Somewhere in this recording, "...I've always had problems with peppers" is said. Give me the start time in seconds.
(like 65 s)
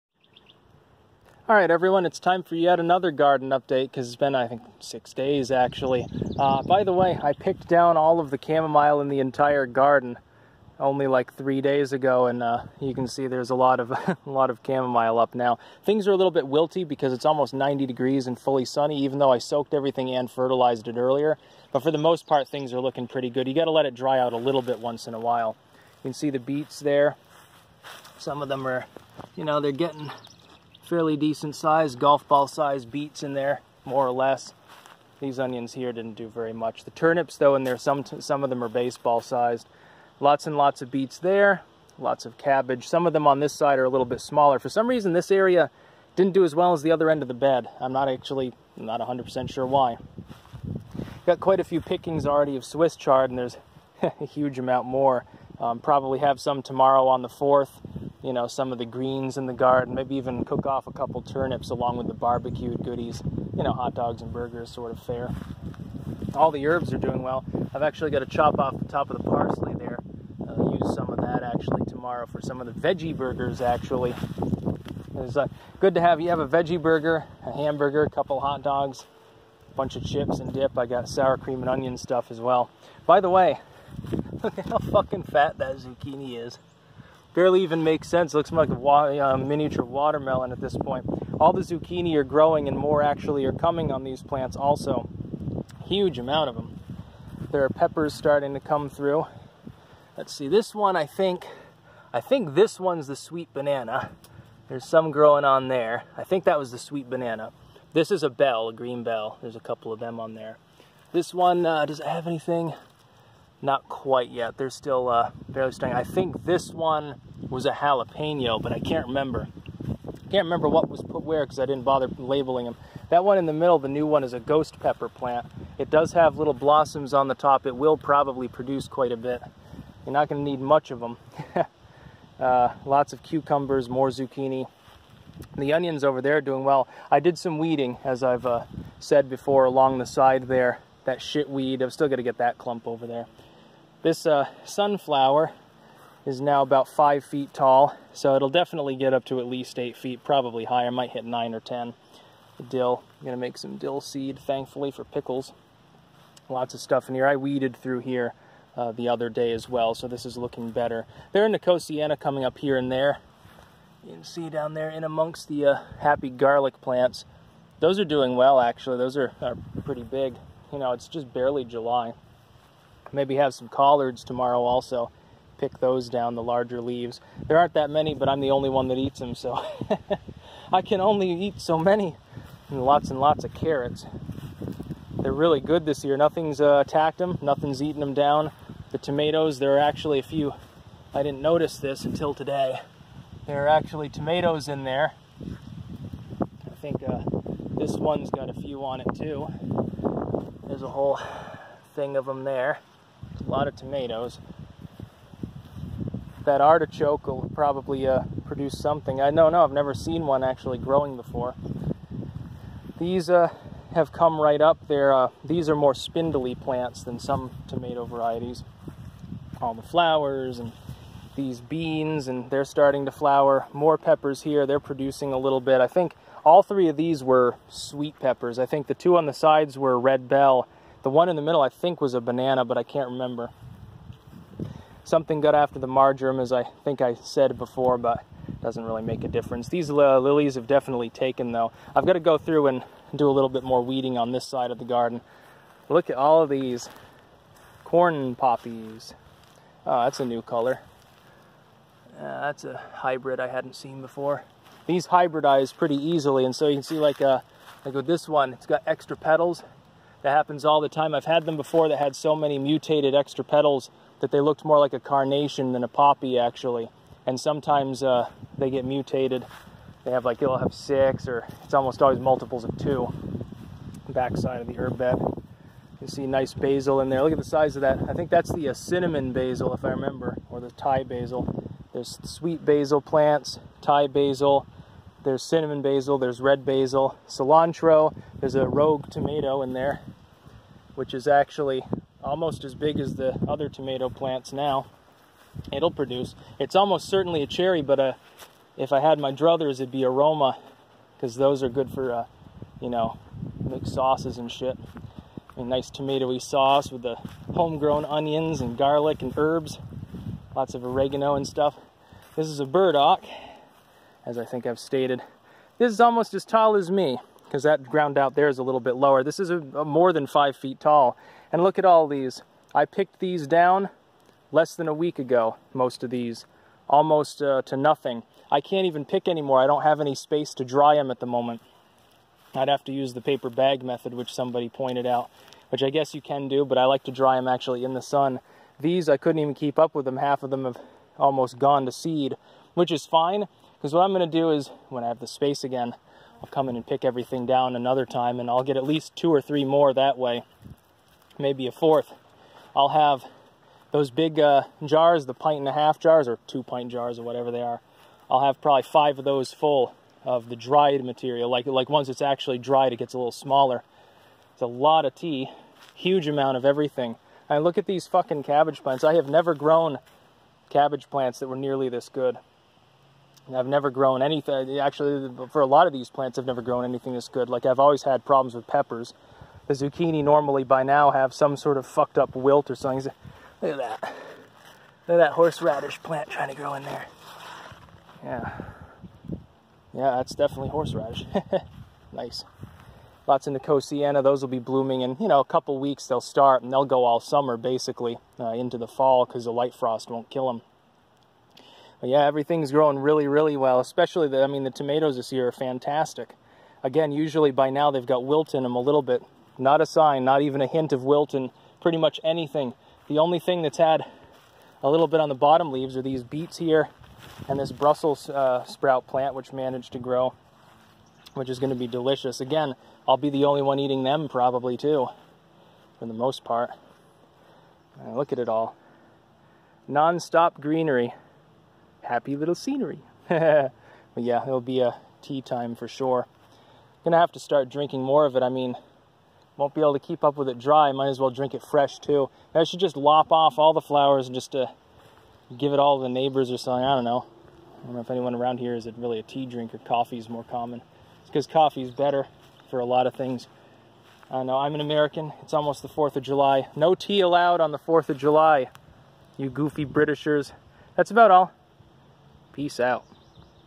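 377 s.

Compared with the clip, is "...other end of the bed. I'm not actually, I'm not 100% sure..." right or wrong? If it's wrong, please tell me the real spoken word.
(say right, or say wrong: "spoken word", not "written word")
right.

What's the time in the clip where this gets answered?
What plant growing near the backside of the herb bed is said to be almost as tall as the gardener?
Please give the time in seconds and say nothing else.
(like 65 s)
312 s.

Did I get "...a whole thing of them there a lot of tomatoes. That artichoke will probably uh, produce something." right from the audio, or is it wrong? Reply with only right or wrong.
right.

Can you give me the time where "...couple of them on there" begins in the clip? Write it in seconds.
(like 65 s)
109 s.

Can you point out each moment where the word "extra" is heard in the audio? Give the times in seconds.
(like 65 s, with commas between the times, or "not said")
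258 s, 263 s.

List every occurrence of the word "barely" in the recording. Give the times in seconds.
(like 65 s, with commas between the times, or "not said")
87 s, 115 s, 171 s.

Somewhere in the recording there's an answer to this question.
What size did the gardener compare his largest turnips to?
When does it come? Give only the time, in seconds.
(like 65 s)
38 s.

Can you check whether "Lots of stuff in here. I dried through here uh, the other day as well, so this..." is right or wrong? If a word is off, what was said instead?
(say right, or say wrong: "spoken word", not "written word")
wrong: "weeded", not "dried".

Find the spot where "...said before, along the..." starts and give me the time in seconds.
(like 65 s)
138 s.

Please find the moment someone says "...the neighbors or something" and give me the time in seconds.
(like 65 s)
446 s.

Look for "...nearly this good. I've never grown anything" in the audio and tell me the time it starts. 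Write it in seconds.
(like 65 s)
371 s.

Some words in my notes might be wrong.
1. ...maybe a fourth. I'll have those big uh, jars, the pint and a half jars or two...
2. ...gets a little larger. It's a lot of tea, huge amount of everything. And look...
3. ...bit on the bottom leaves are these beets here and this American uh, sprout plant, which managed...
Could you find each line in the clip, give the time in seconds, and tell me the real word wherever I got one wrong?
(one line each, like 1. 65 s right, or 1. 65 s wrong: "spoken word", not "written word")
1. 351 s right
2. 362 s wrong: "smaller", not "larger"
3. 415 s wrong: "Brussels", not "American".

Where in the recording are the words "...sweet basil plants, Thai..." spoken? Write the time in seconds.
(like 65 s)
282 s.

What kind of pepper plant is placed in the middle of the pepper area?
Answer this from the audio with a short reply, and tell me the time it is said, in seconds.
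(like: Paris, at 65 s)
ghost pepper, at 124 s.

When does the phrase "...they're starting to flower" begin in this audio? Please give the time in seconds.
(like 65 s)
222 s.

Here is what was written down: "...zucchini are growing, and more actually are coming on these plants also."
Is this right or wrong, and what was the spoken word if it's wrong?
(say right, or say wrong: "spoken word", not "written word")
right.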